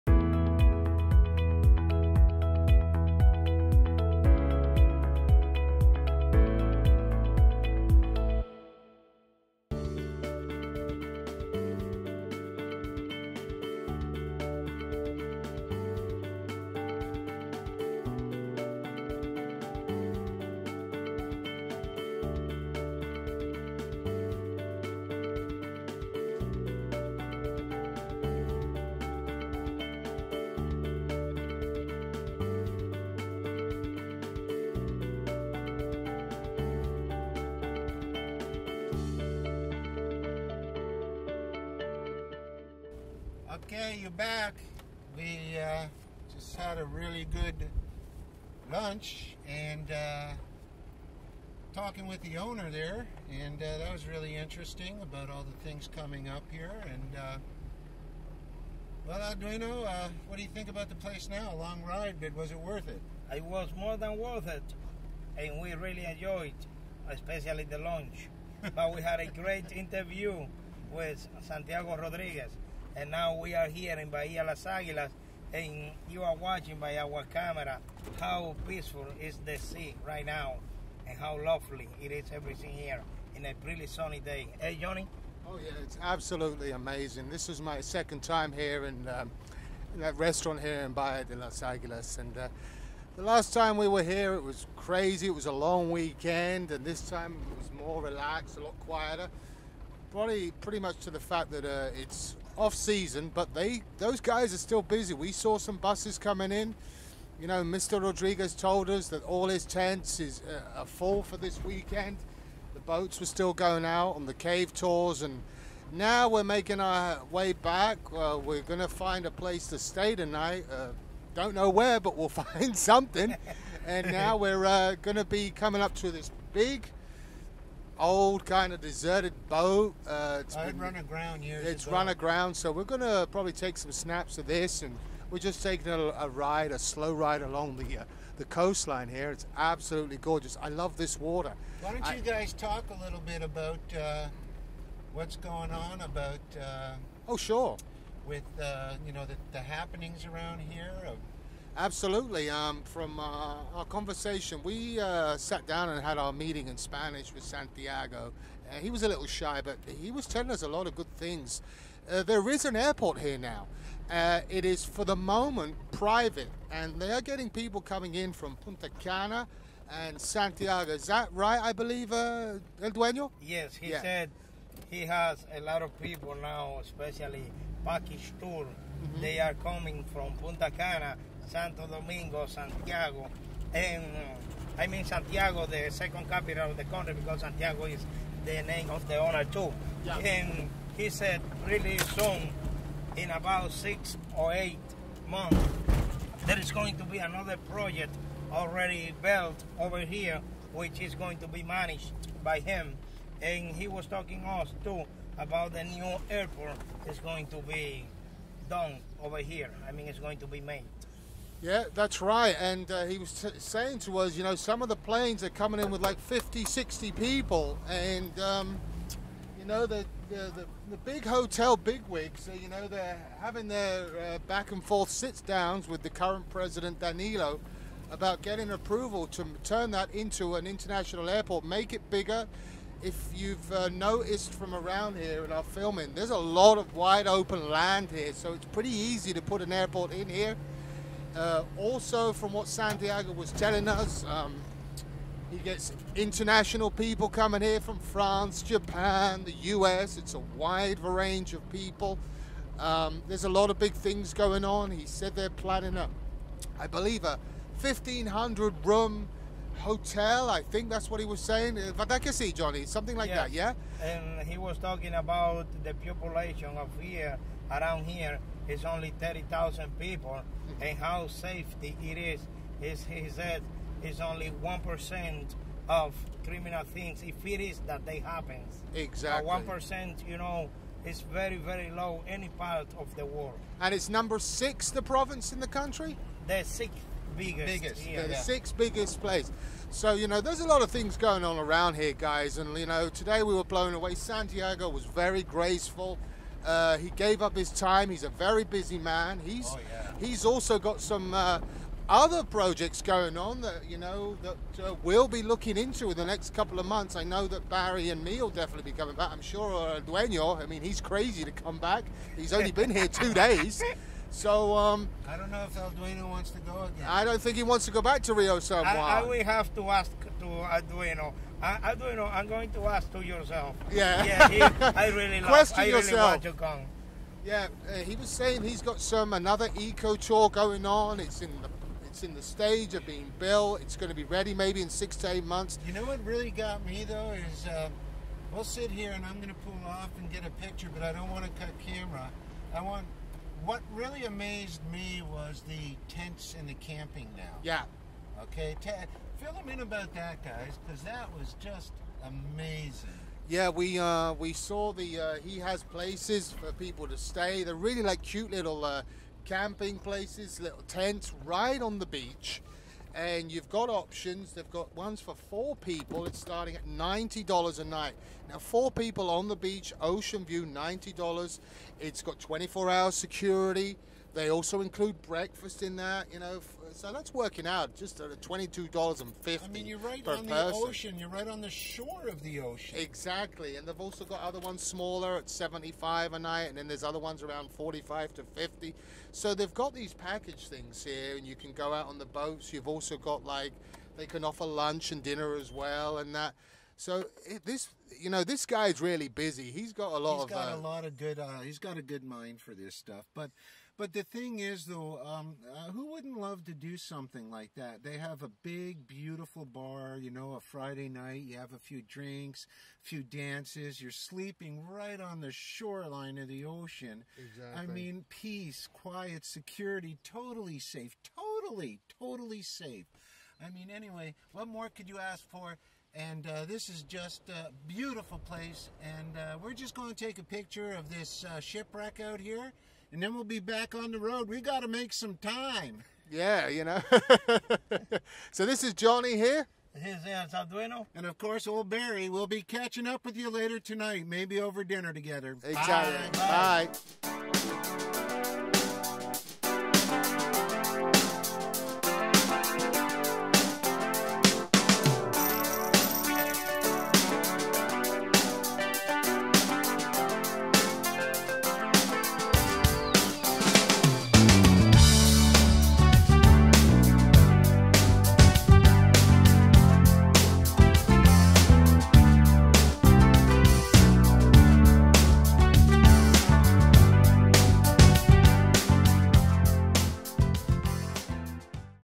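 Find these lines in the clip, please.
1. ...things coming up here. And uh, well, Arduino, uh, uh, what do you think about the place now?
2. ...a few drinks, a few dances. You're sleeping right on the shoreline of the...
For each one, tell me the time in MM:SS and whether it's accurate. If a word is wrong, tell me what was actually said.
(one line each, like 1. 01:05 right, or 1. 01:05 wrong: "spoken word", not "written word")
1. 00:55 right
2. 06:51 right.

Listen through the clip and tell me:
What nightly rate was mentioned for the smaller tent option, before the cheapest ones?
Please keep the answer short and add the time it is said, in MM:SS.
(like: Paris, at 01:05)
$75, at 06:25.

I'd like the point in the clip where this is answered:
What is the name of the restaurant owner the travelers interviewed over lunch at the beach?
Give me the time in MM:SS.
01:11.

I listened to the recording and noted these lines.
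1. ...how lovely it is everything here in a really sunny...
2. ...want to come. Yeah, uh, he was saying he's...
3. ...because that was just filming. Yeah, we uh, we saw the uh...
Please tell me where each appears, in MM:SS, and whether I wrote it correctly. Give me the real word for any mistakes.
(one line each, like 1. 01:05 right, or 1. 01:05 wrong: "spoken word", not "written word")
1. 01:21 right
2. 05:26 right
3. 05:50 wrong: "amazing", not "filming".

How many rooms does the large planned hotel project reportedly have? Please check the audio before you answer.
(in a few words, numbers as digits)
1,500.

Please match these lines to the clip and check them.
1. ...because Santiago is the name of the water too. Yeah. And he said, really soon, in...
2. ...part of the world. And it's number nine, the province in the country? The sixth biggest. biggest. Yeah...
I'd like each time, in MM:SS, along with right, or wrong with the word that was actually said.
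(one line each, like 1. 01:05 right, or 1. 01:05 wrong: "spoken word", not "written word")
1. 03:07 wrong: "owner", not "water"
2. 04:42 wrong: "six", not "nine".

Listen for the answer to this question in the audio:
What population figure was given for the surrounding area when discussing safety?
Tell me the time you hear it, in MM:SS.
04:29.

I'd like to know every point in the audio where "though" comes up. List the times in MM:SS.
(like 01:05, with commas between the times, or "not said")
05:37, 06:44.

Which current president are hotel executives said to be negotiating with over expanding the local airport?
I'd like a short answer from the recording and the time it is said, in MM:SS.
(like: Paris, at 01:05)
Danilo, at 03:46.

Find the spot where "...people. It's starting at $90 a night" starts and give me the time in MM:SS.
06:05.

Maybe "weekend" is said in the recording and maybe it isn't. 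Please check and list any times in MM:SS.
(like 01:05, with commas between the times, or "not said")
01:35, 01:51.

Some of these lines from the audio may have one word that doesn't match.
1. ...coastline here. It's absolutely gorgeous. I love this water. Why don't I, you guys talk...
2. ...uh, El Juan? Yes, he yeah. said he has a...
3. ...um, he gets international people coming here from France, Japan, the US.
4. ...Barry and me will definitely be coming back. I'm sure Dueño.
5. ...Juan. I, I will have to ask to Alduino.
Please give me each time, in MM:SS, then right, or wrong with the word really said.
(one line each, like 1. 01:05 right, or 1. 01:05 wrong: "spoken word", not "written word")
1. 02:18 right
2. 02:52 wrong: "Dueño", not "Juan"
3. 04:04 right
4. 05:07 right
5. 05:18 right.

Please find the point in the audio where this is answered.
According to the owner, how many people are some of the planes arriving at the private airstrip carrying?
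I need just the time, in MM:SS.
03:36.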